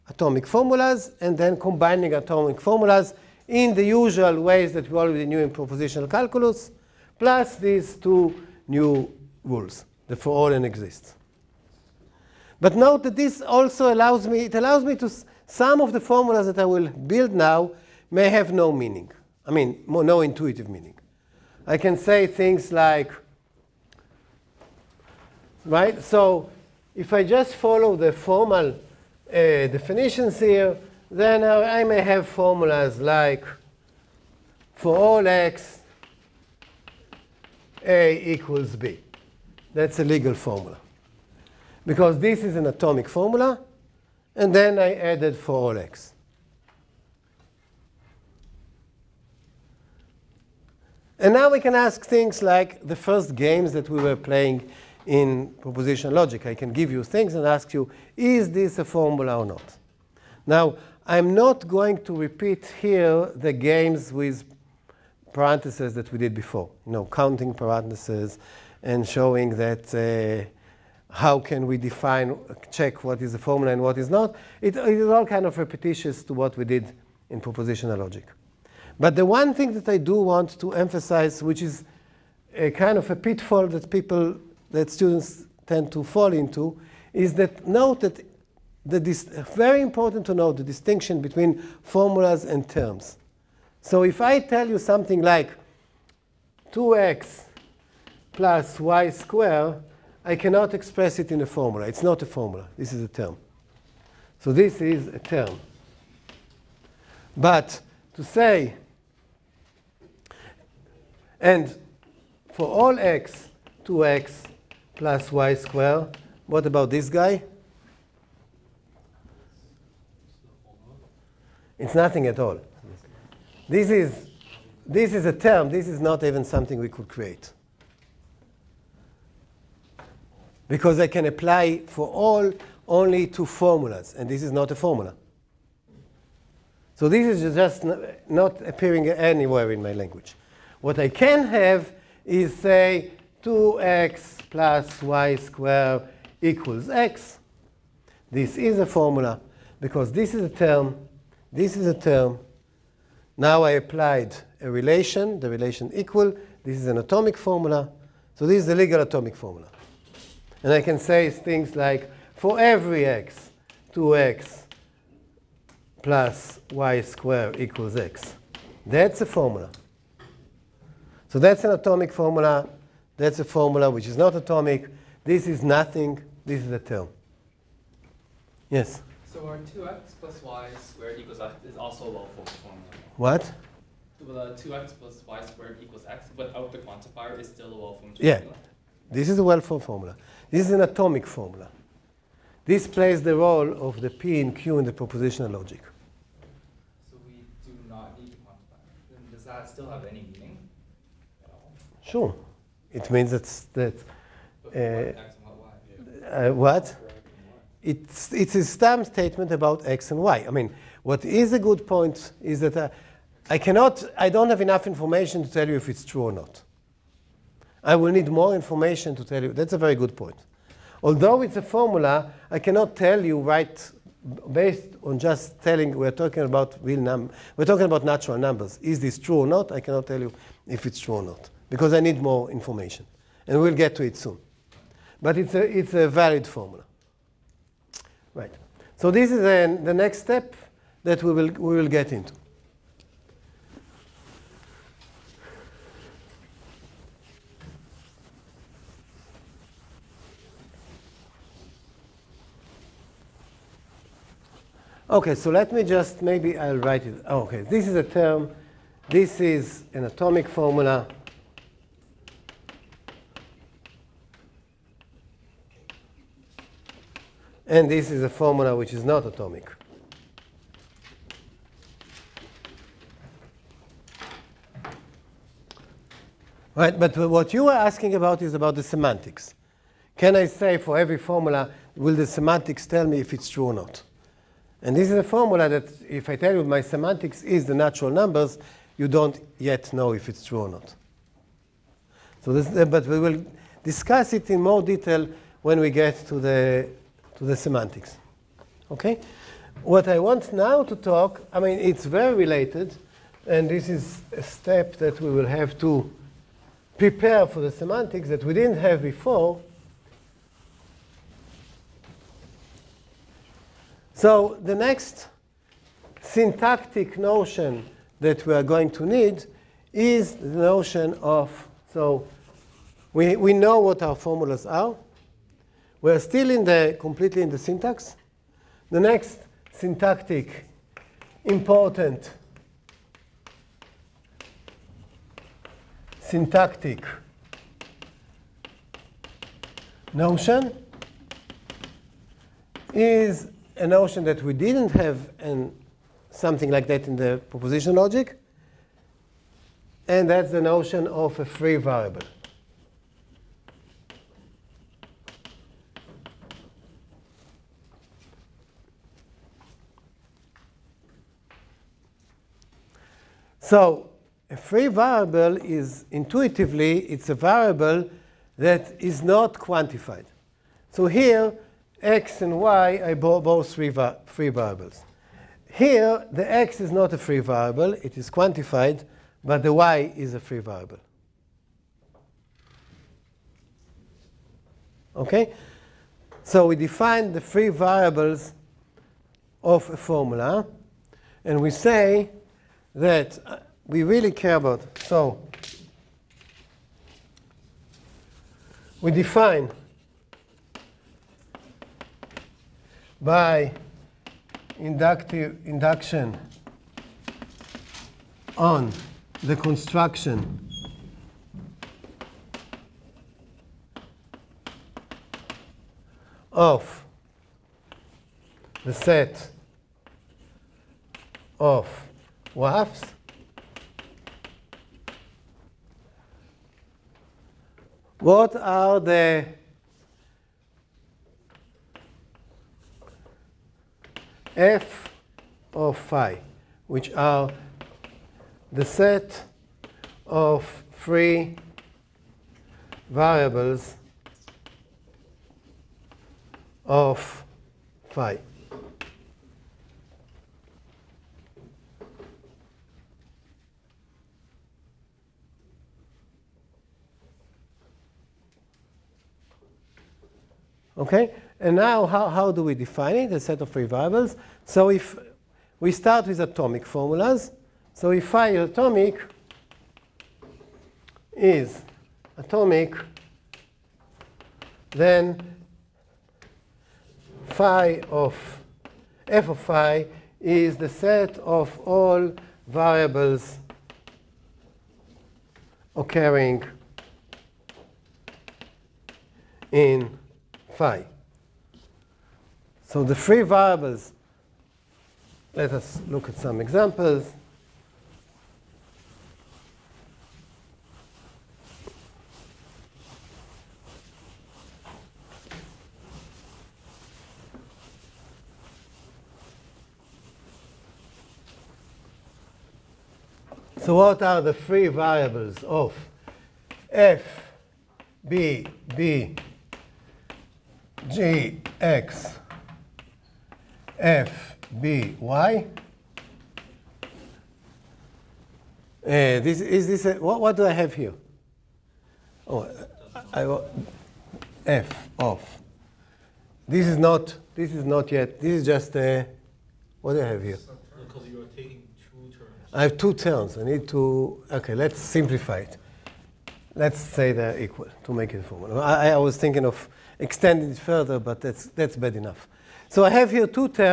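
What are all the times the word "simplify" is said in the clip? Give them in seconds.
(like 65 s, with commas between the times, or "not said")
544 s.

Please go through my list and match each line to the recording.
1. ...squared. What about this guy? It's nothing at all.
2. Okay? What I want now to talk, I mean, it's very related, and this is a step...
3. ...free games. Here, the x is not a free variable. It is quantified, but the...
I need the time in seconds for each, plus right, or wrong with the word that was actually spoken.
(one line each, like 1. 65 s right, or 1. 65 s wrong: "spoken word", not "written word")
1. 115 s right
2. 298 s right
3. 374 s wrong: "variables", not "games".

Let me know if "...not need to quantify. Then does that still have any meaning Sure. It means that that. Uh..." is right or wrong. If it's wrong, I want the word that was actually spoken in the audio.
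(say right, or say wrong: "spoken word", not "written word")
right.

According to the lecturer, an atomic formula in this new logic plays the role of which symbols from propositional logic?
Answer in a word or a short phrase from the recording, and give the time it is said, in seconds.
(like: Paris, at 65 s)
p and q, at 193 s.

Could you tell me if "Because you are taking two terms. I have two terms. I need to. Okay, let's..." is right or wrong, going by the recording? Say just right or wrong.
right.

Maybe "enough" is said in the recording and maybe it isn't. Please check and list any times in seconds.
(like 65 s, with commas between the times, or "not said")
214 s, 552 s.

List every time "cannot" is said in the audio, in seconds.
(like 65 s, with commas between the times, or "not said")
100 s, 213 s, 222 s, 229 s.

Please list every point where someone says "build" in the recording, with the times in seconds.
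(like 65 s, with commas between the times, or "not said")
16 s.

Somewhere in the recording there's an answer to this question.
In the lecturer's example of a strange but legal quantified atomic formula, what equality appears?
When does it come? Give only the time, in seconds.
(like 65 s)
37 s.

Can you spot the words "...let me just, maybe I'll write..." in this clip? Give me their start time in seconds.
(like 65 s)
255 s.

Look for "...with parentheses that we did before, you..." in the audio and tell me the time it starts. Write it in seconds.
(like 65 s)
64 s.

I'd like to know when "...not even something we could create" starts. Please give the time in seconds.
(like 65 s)
126 s.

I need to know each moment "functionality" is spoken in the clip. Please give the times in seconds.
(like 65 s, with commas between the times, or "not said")
not said.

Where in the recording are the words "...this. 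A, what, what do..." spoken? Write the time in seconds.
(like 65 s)
529 s.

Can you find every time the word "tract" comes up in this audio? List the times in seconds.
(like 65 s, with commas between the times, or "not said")
not said.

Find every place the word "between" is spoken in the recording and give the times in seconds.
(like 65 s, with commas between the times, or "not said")
91 s.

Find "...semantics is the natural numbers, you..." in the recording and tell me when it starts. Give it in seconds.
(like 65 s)
286 s.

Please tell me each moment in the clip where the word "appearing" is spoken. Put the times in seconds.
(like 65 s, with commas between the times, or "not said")
138 s.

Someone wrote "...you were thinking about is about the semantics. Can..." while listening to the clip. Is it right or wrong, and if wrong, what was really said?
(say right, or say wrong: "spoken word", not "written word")
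wrong: "asking", not "thinking".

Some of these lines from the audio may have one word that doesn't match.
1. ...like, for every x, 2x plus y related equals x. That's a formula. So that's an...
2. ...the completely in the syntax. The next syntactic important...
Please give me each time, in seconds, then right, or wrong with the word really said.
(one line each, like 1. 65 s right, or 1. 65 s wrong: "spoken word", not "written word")
1. 161 s wrong: "squared", not "related"
2. 326 s right.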